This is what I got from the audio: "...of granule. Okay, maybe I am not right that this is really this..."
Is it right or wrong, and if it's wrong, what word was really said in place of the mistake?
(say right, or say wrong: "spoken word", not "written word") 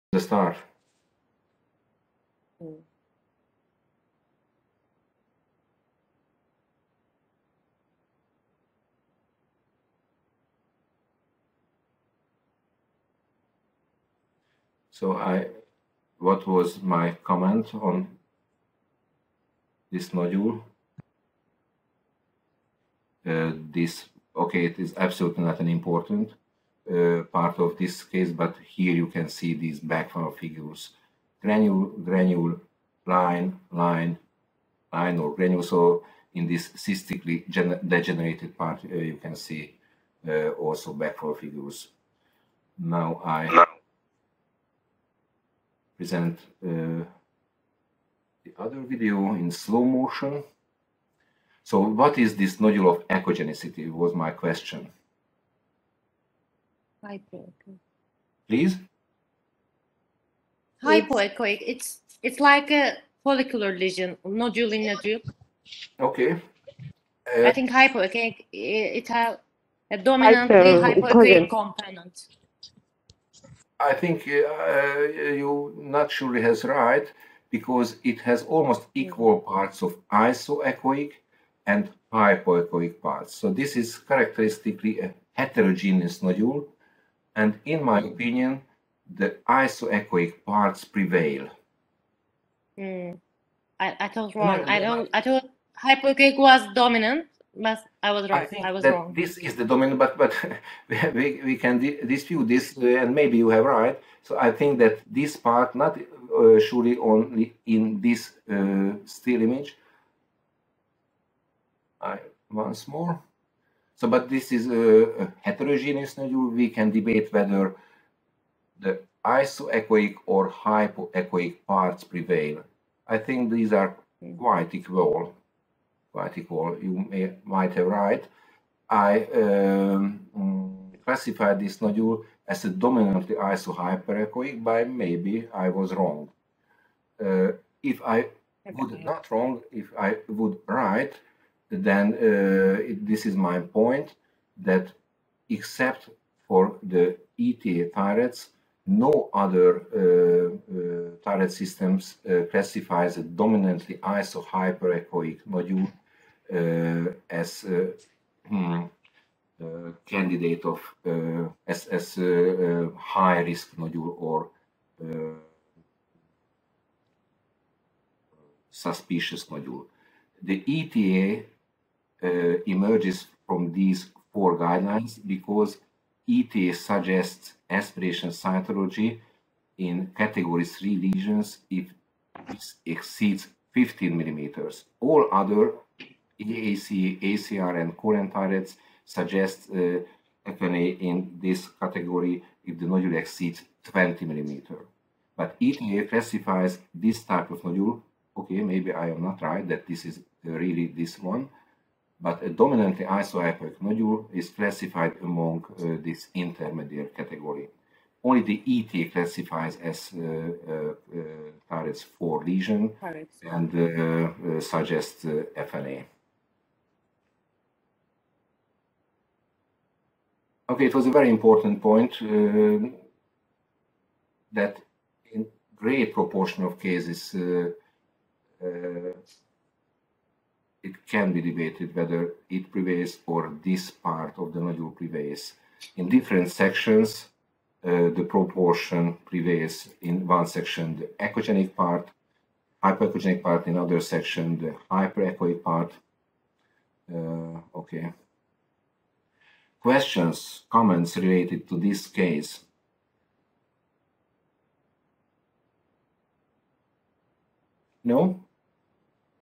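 wrong: "nodule", not "granule".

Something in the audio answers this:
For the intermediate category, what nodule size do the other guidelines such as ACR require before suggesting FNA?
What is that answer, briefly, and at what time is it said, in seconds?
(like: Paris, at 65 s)
20 millimeters, at 193 s.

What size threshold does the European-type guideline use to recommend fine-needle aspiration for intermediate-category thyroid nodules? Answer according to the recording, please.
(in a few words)
15 millimeters.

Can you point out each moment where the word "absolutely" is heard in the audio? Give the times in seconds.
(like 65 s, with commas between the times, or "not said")
24 s.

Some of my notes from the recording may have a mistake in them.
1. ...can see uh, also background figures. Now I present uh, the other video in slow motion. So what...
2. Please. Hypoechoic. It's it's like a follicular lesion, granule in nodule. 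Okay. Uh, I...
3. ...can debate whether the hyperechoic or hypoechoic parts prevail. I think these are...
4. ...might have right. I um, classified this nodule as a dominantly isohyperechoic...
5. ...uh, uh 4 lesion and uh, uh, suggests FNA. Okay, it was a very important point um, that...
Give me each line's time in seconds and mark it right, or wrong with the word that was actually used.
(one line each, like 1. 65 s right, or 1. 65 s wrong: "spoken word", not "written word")
1. 39 s right
2. 58 s wrong: "nodule", not "granule"
3. 116 s wrong: "isoechoic", not "hyperechoic"
4. 127 s right
5. 212 s right.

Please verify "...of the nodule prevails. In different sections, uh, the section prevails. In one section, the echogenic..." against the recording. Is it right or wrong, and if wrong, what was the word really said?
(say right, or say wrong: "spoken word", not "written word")
wrong: "proportion", not "section".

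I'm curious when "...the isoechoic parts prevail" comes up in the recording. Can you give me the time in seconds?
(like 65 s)
89 s.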